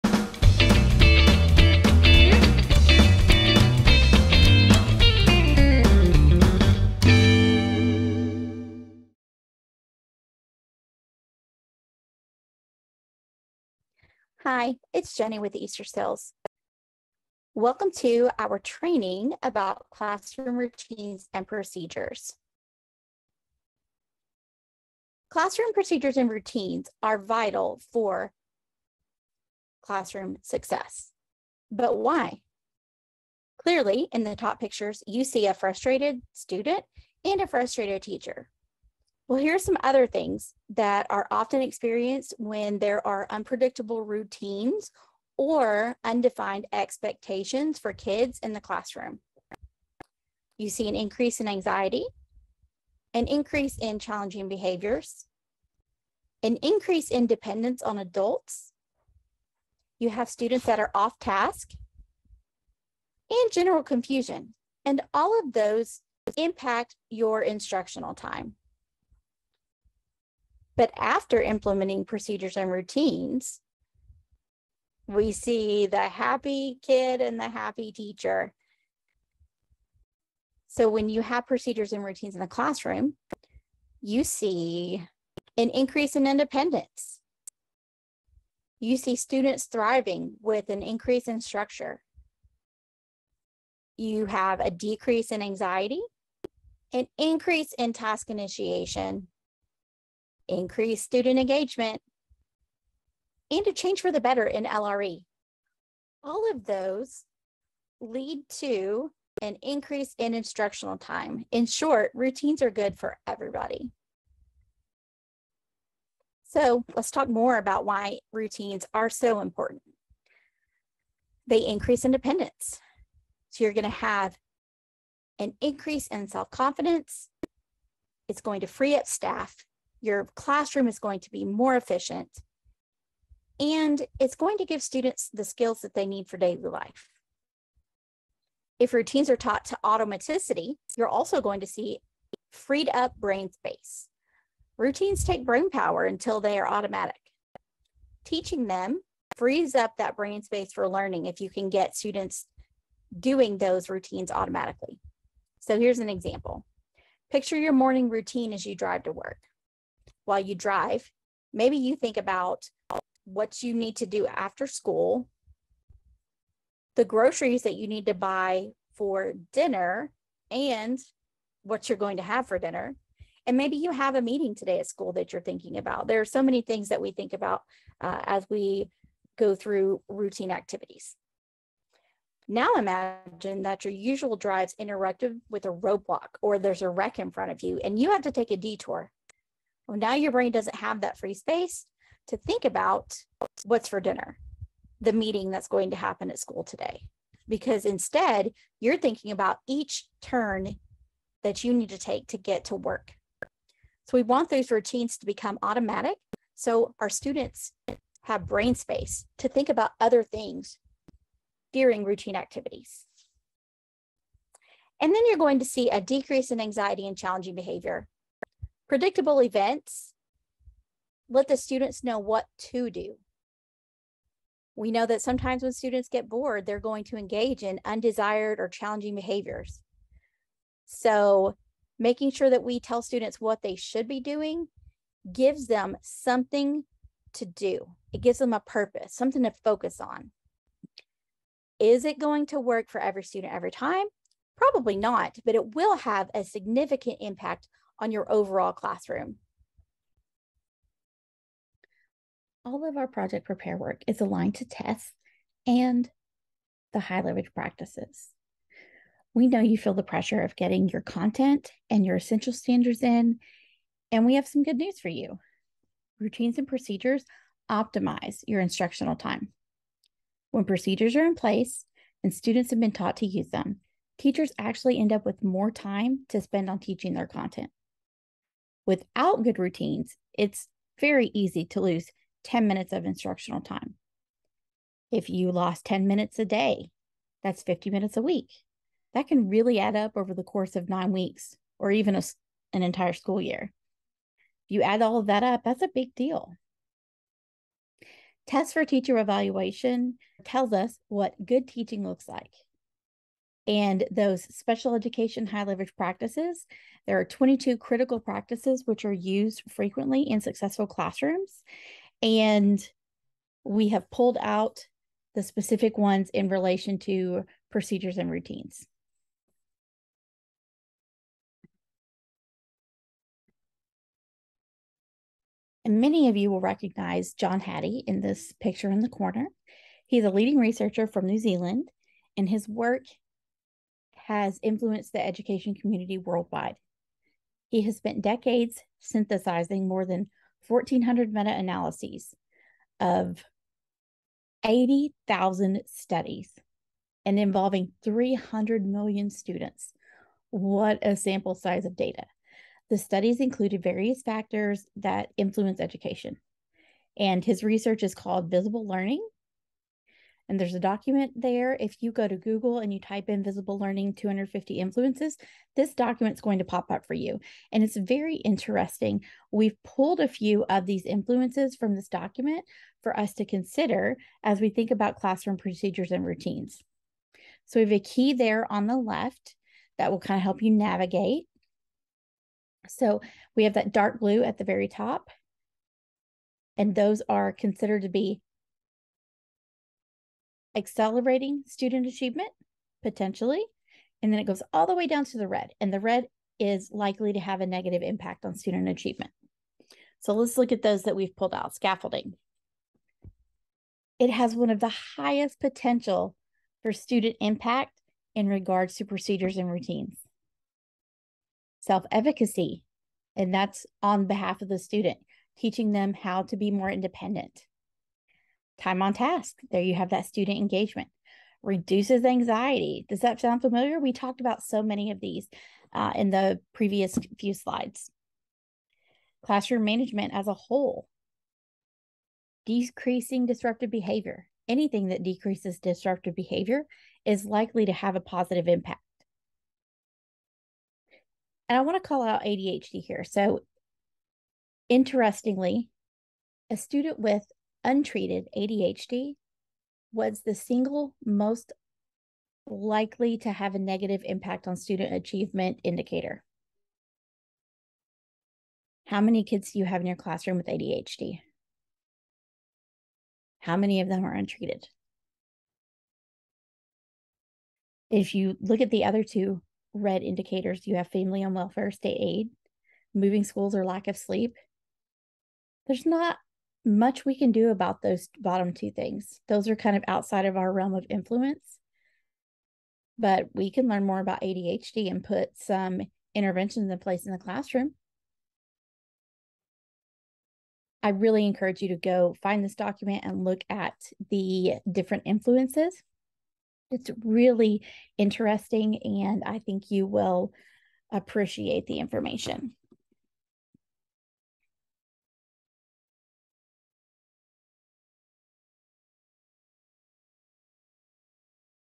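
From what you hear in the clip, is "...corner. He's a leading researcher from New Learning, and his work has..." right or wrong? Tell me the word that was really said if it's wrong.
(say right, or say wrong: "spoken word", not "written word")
wrong: "Zealand", not "Learning".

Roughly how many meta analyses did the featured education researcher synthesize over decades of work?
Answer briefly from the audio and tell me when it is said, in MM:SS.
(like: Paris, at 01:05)
1,400, at 05:40.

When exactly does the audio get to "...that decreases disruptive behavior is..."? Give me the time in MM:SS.
07:15.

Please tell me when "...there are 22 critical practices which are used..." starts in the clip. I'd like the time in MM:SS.
05:07.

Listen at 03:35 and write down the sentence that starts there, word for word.
And then you're going to see a decrease in anxiety and challenging behavior predictable events, let the students know what to do.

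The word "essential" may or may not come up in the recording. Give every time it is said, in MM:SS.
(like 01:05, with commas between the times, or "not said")
04:22.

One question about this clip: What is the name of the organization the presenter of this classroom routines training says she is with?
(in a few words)
Easterseals.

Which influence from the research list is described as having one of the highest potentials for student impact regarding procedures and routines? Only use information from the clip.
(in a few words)
Scaffolding.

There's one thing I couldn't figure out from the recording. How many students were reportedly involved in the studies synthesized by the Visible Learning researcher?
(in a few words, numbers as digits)
300 million.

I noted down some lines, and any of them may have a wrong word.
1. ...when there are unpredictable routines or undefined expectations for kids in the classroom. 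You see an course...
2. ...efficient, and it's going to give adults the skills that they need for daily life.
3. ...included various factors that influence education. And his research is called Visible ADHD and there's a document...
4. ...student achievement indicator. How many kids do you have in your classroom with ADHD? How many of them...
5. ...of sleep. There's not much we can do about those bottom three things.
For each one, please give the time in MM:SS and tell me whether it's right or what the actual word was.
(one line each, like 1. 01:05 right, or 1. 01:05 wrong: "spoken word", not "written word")
1. 00:42 wrong: "increase", not "course"
2. 02:11 wrong: "students", not "adults"
3. 05:53 wrong: "Learning", not "ADHD"
4. 07:34 right
5. 07:54 wrong: "two", not "three".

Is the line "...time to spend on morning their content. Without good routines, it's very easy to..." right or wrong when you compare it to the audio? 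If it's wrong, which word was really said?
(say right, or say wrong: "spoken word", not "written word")
wrong: "teaching", not "morning".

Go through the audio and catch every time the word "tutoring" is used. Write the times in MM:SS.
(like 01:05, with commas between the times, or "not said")
not said.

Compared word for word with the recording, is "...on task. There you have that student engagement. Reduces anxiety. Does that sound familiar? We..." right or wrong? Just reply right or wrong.
right.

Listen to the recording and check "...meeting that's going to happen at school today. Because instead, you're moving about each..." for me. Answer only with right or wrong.
wrong.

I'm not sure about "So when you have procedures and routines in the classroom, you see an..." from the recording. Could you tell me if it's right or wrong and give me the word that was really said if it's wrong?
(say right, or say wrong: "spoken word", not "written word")
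right.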